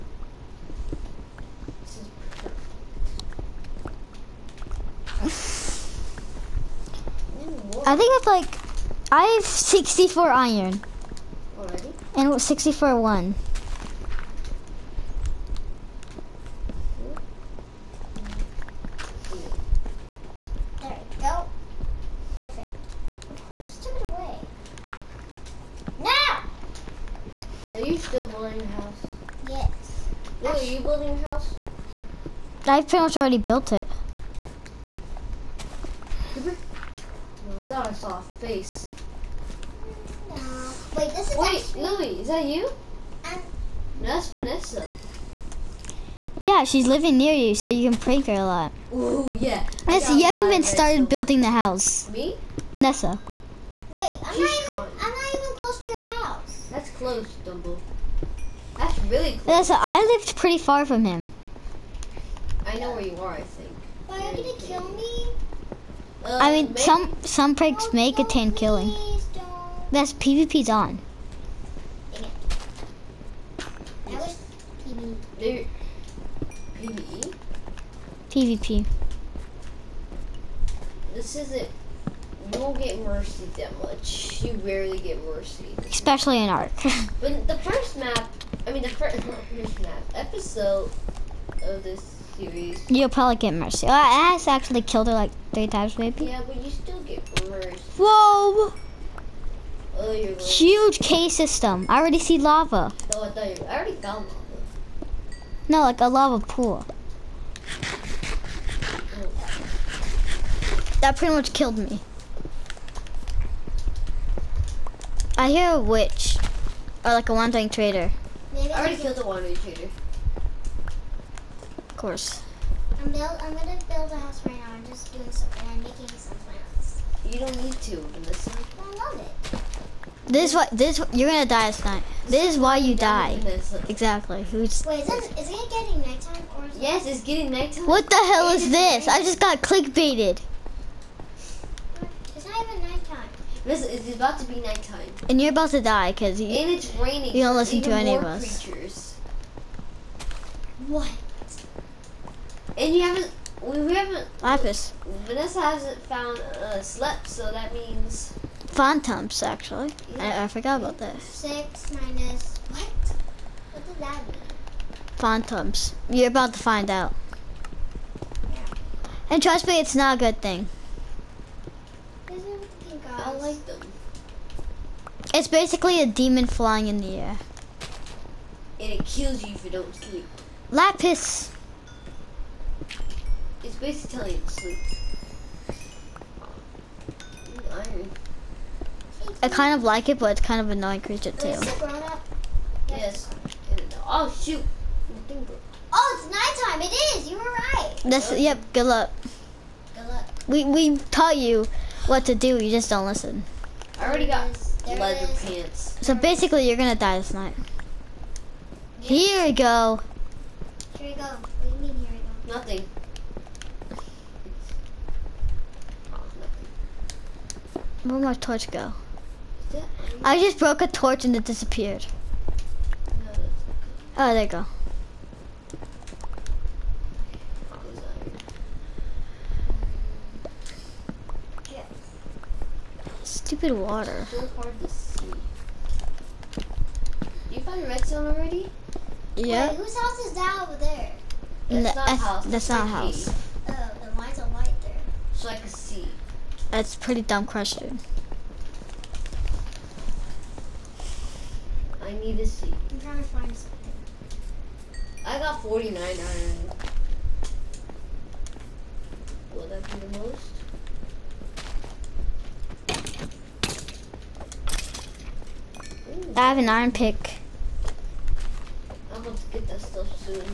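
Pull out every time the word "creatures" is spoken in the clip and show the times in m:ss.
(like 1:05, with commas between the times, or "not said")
2:28, 3:11.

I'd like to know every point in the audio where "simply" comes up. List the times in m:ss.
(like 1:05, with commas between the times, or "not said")
not said.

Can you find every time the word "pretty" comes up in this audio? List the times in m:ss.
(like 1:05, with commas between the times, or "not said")
1:00, 1:51, 4:06.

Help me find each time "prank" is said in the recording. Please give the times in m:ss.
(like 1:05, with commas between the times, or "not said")
0:47, 1:07.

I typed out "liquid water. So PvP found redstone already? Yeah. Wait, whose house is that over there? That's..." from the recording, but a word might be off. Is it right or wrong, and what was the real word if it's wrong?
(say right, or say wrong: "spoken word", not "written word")
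wrong: "You", not "PvP".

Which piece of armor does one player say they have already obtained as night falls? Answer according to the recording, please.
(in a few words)
leather pants.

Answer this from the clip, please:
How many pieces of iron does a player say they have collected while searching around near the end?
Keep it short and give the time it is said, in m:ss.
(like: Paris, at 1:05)
49, at 4:15.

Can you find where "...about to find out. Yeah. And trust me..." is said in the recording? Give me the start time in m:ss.
2:46.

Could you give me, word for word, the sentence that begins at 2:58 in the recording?
And it kills you if you don't sleep.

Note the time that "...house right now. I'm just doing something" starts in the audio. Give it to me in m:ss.
2:04.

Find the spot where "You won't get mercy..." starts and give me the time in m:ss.
1:22.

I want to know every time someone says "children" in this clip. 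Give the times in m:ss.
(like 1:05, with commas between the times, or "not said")
not said.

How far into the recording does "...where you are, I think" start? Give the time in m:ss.
1:02.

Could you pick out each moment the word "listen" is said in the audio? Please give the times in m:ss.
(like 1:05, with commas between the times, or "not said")
2:08, 2:27, 3:23.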